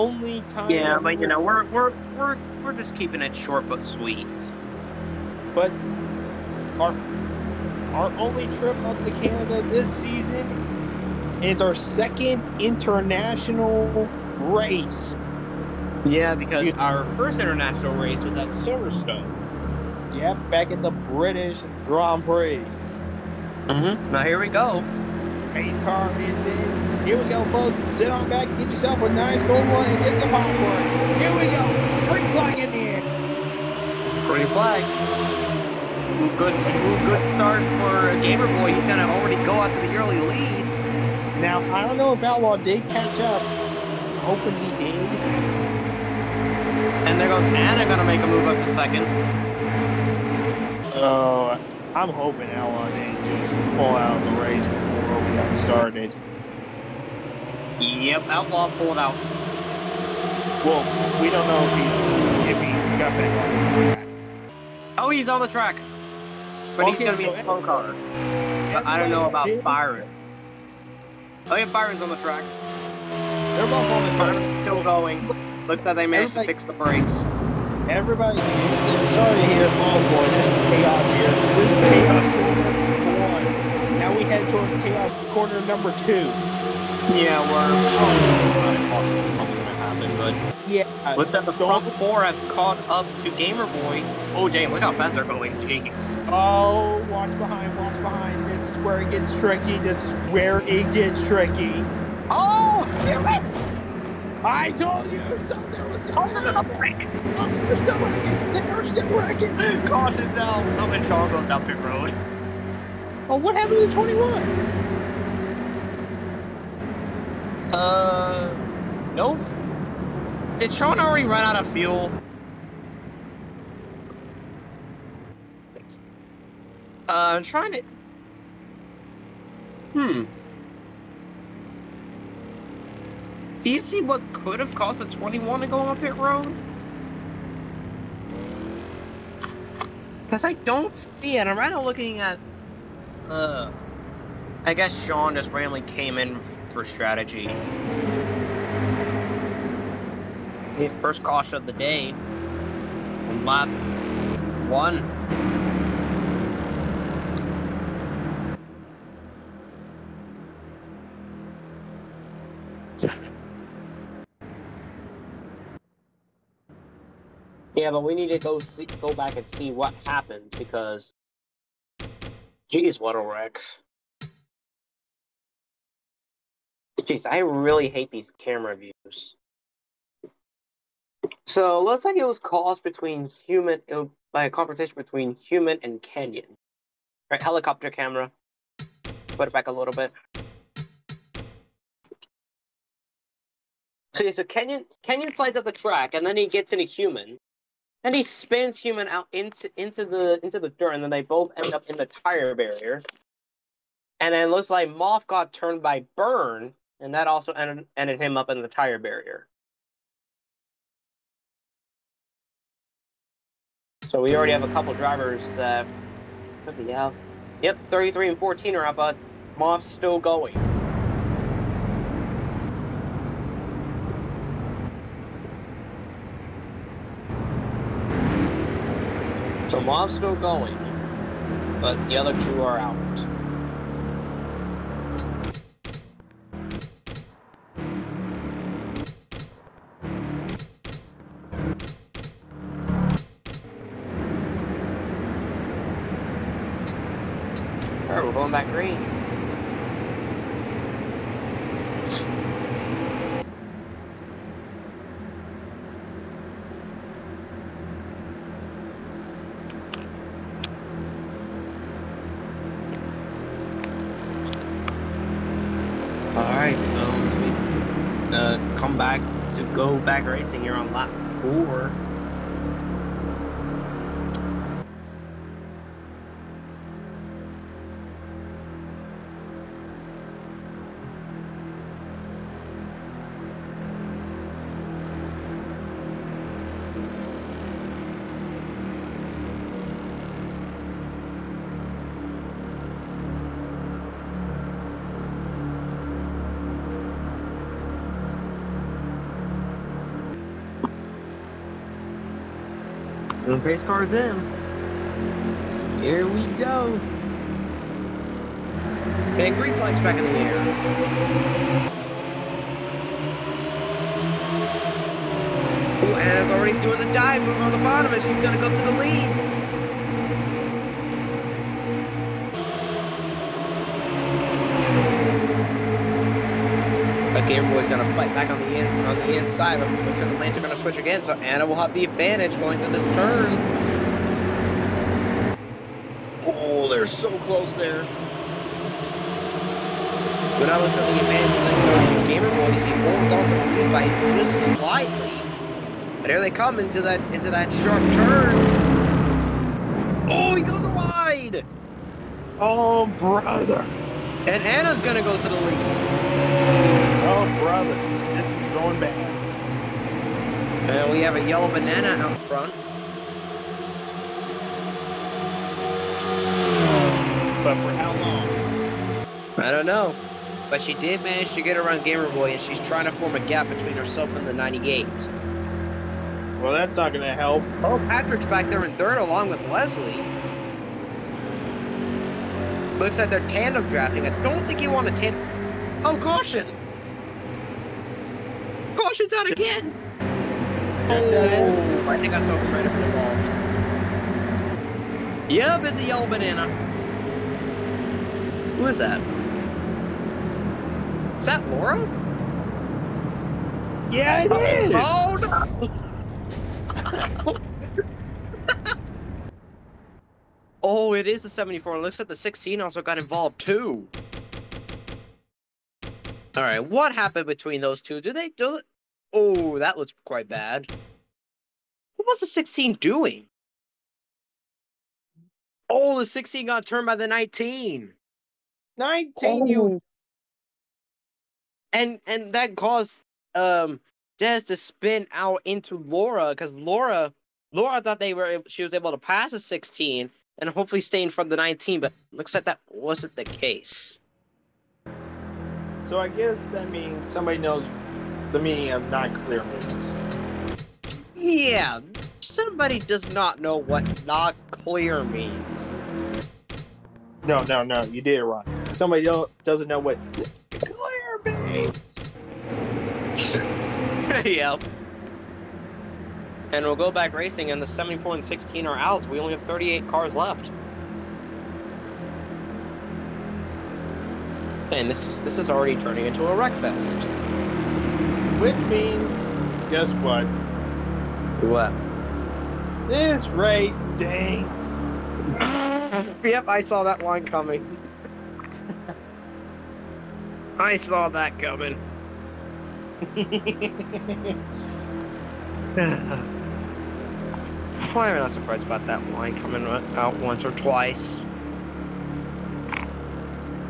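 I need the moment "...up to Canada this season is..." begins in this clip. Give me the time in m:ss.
0:08.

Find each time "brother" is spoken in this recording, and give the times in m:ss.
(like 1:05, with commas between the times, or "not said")
5:53, 5:57.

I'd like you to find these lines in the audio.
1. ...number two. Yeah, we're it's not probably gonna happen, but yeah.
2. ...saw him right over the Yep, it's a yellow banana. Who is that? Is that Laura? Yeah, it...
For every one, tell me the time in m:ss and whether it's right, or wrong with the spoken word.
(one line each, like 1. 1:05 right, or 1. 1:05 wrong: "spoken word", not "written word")
1. 1:25 right
2. 6:32 right.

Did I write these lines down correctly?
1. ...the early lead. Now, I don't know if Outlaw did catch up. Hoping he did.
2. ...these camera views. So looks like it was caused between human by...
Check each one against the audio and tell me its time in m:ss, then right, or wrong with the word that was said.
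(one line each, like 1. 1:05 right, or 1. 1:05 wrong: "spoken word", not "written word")
1. 0:39 right
2. 2:58 right.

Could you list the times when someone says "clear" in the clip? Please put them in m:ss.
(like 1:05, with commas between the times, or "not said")
7:29, 7:34, 7:40.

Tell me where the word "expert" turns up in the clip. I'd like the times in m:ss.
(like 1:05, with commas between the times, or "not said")
not said.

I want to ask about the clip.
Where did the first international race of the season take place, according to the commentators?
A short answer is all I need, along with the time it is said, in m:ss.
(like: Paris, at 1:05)
Silverstone, at 0:18.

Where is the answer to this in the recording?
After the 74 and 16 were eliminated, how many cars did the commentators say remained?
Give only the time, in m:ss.
7:49.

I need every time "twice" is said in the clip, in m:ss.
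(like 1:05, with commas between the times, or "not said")
8:20.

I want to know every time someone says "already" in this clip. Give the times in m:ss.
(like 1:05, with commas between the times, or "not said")
0:39, 2:00, 3:34, 5:16, 7:55.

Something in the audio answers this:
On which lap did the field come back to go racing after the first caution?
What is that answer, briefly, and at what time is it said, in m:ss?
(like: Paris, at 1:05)
Lap 4, at 4:30.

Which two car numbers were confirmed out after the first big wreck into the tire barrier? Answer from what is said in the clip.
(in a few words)
33 and 14.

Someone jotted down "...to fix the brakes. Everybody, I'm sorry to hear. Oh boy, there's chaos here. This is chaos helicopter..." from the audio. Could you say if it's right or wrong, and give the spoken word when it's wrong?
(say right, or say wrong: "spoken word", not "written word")
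wrong: "corner", not "helicopter".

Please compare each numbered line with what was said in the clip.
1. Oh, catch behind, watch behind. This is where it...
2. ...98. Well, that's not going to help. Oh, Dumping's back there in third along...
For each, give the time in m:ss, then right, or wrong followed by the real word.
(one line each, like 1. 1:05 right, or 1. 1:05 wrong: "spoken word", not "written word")
1. 1:36 wrong: "watch", not "catch"
2. 6:14 wrong: "Patrick", not "Dumping".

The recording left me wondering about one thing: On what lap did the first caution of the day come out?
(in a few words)
Lap 1.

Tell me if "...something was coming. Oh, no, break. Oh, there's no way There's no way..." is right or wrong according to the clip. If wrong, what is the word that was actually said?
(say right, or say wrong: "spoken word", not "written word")
right.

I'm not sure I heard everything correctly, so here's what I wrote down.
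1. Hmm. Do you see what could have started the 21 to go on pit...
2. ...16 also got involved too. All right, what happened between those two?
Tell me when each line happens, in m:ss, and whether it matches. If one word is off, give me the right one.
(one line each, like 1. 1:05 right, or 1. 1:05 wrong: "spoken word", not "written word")
1. 2:09 wrong: "caused", not "started"
2. 6:52 right.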